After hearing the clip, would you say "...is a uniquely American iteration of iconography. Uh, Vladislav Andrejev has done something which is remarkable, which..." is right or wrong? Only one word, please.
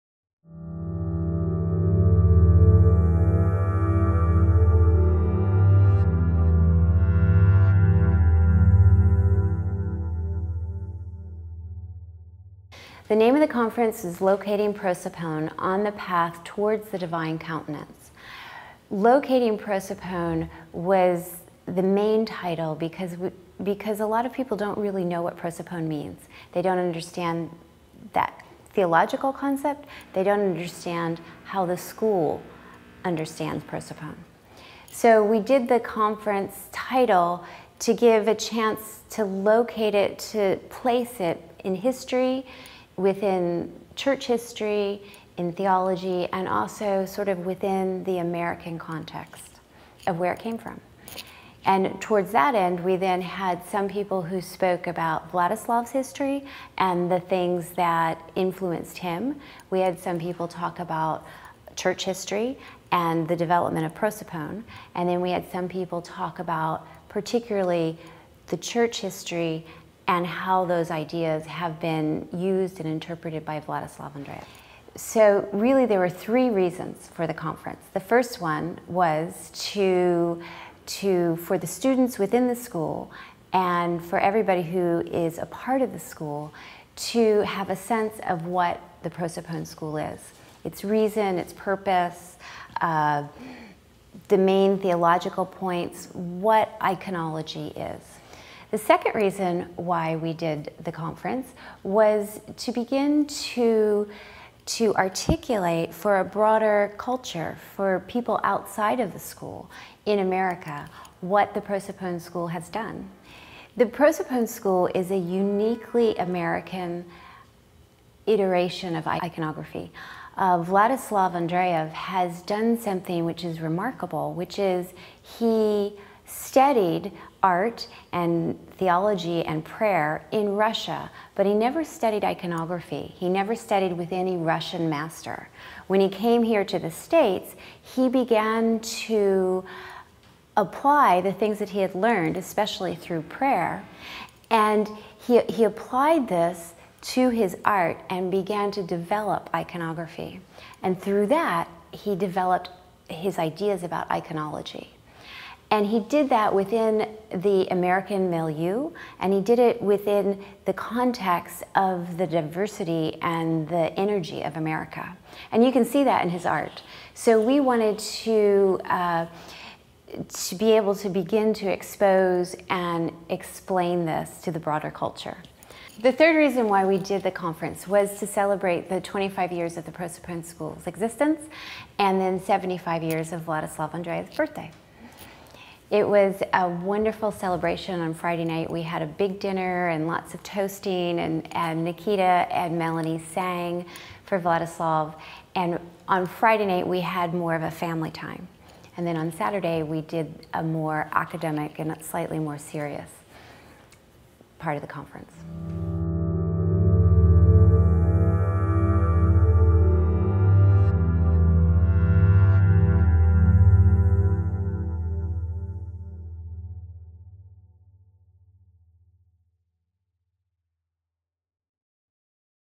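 right.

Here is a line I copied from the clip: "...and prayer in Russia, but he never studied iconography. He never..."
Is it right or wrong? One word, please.
right.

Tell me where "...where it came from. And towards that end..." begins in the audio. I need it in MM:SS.
00:50.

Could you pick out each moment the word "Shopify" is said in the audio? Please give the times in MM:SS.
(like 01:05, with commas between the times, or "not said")
not said.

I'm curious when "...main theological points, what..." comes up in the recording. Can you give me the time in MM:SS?
01:34.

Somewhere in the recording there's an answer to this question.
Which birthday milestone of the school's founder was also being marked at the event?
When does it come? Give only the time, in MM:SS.
03:02.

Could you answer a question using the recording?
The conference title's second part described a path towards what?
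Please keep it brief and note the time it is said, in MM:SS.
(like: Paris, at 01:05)
The Divine Countenance, at 00:16.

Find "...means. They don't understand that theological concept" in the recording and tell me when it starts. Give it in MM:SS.
00:25.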